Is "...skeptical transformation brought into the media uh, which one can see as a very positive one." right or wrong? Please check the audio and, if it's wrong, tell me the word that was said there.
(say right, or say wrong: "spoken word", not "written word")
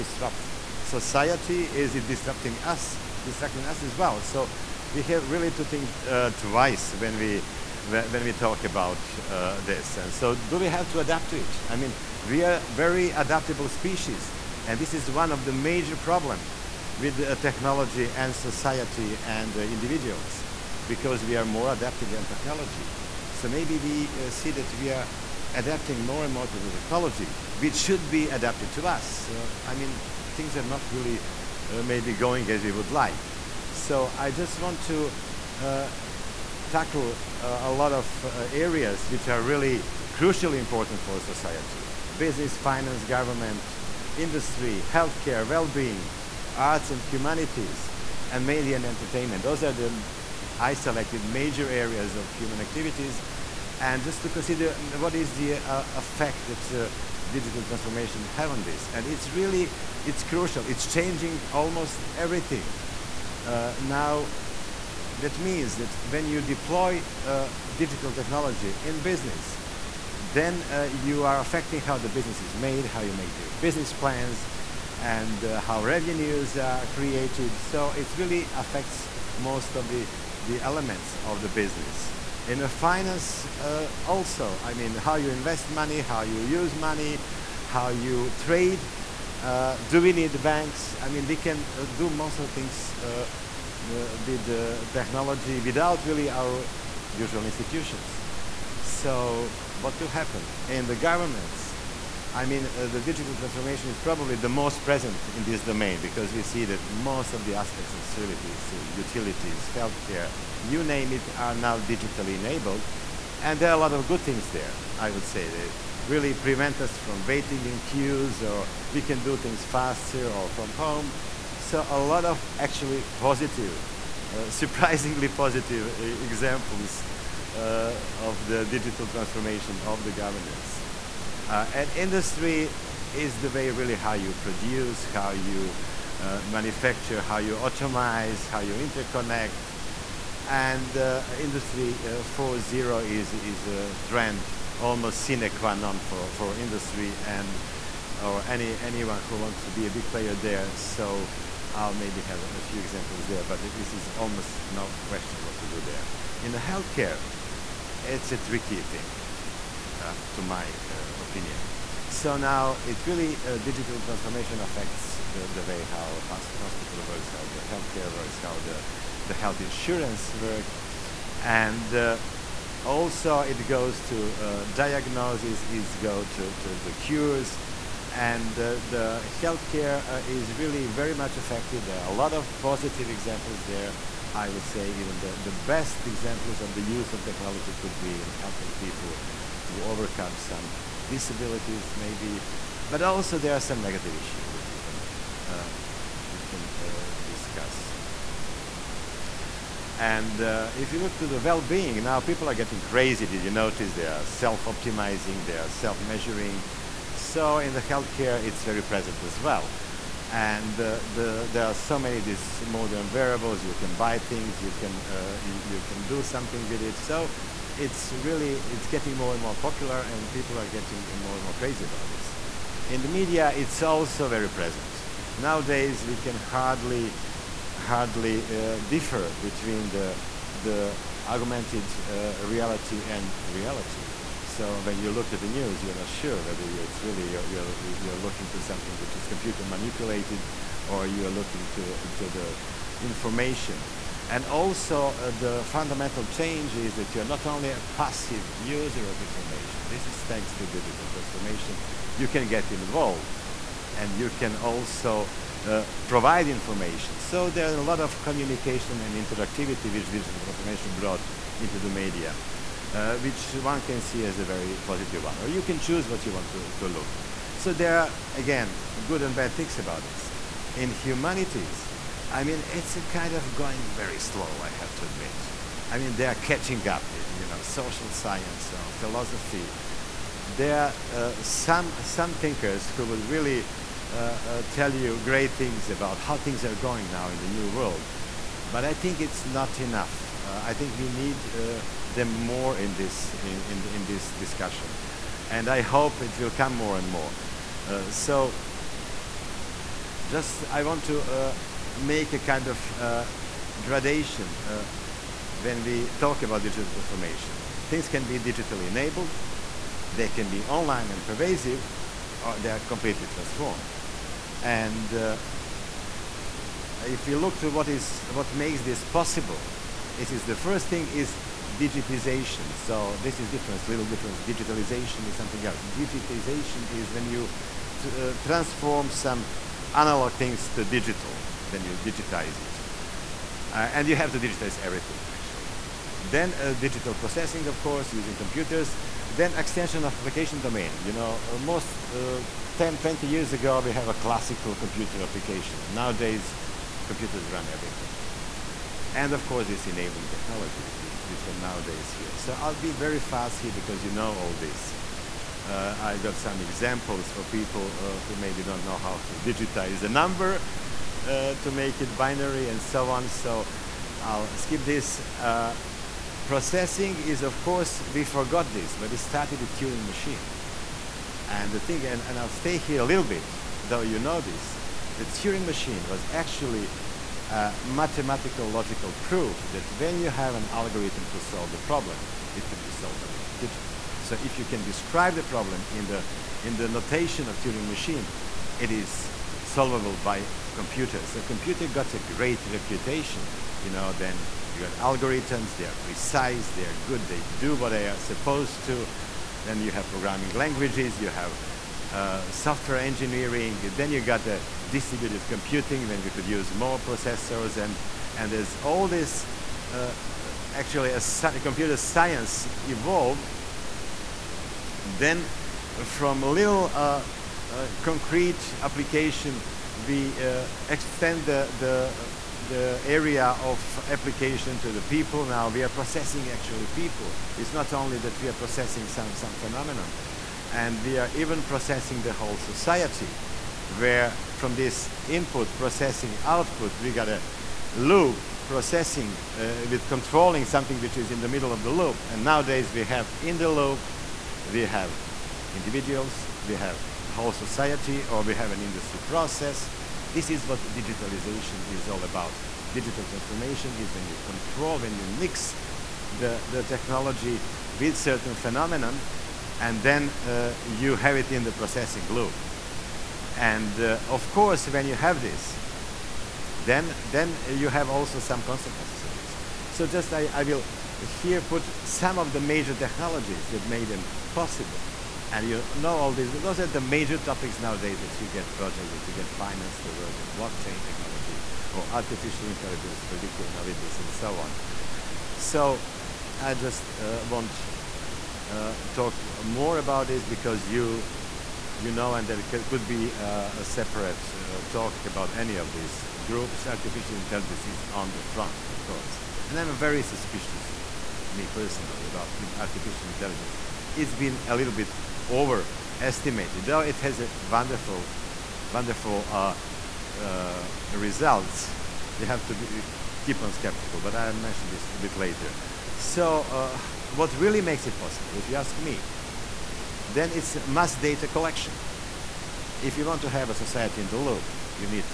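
wrong: "digital", not "skeptical".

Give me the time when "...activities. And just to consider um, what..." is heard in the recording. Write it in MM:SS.
00:52.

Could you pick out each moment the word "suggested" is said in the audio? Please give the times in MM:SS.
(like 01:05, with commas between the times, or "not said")
not said.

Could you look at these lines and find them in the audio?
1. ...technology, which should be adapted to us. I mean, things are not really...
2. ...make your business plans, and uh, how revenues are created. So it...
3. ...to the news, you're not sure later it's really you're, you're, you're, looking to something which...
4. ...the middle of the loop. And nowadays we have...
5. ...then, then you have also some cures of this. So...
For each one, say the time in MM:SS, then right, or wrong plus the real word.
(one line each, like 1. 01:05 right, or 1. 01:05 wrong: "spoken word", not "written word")
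1. 00:26 right
2. 01:13 right
3. 03:55 wrong: "whether", not "later"
4. 07:21 right
5. 07:46 wrong: "consequences", not "cures".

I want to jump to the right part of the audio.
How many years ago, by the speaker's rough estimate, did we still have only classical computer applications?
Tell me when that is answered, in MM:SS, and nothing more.
05:42.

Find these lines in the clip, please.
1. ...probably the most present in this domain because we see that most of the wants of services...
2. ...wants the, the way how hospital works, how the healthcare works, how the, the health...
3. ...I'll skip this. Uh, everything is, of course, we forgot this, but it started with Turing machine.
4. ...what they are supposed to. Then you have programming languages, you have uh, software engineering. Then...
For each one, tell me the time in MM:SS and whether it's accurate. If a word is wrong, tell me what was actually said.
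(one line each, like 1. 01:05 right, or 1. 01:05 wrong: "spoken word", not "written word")
1. 01:44 wrong: "aspects", not "wants"
2. 02:44 wrong: "affects", not "wants"
3. 06:04 wrong: "processing", not "everything"
4. 06:37 right.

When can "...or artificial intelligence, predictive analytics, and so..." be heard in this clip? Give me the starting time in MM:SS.
08:01.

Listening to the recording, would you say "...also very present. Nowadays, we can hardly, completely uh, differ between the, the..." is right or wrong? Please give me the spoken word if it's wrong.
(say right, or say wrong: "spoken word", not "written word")
wrong: "hardly", not "completely".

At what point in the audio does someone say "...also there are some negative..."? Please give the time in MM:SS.
03:13.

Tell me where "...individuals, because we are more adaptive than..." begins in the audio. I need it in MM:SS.
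00:19.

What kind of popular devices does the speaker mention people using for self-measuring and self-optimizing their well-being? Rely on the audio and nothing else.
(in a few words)
Wearables.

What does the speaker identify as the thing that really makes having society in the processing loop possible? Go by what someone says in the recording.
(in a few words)
Mass data collection.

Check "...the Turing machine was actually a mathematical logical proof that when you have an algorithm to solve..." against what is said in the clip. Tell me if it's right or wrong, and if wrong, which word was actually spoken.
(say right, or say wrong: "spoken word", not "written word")
right.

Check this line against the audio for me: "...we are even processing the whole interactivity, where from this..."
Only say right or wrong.
wrong.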